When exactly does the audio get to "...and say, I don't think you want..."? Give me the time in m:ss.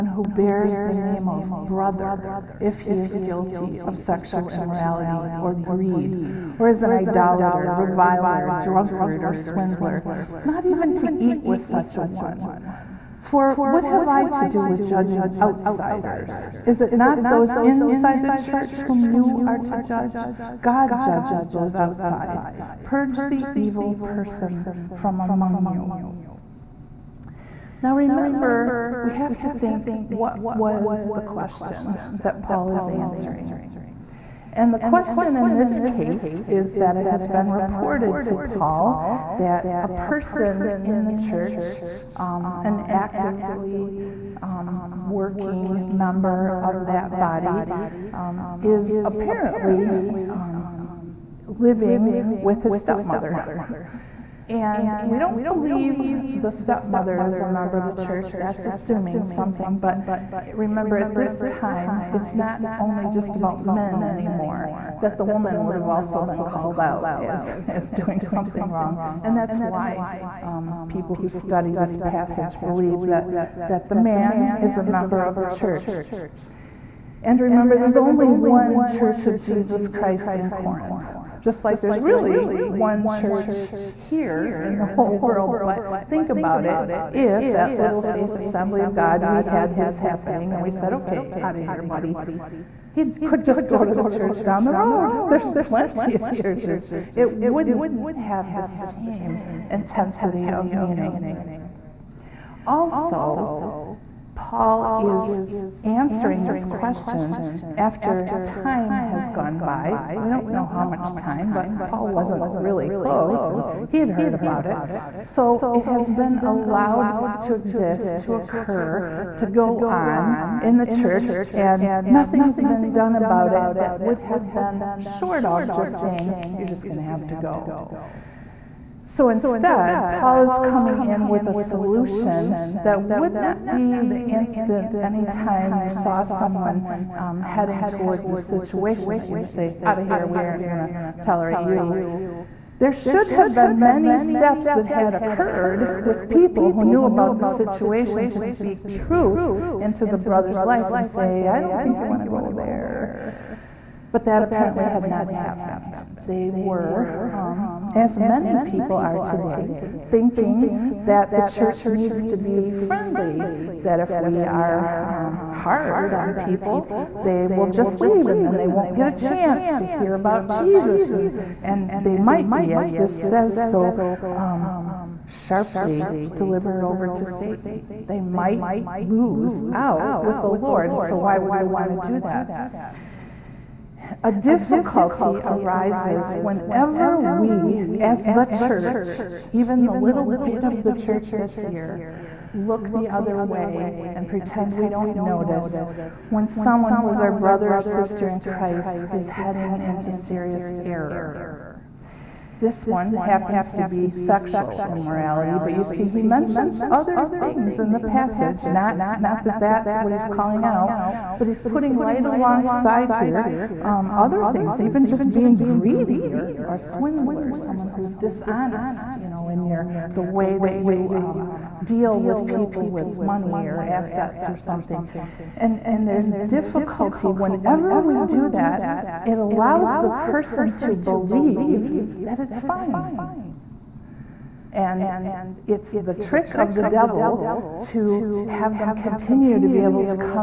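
2:30.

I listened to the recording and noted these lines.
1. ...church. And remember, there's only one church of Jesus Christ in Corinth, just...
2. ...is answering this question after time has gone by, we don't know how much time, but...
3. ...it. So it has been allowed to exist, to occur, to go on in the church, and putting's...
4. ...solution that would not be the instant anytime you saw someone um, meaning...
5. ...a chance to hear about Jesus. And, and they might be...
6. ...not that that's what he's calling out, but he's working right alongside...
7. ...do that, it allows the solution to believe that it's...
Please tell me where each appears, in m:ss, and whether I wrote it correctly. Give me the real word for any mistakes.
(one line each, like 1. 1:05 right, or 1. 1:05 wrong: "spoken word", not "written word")
1. 1:15 right
2. 1:44 right
3. 1:54 wrong: "nothing", not "putting"
4. 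2:11 wrong: "heading", not "meaning"
5. 2:49 right
6. 3:29 wrong: "putting", not "working"
7. 3:48 wrong: "person", not "solution".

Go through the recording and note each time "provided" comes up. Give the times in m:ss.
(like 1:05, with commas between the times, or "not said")
not said.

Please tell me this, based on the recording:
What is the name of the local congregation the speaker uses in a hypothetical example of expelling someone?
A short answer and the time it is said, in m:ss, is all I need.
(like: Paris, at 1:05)
Little Faith Assembly of God, at 1:27.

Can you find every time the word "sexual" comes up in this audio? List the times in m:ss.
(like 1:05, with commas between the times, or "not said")
0:03, 3:24.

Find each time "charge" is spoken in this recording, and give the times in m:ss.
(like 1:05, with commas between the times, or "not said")
not said.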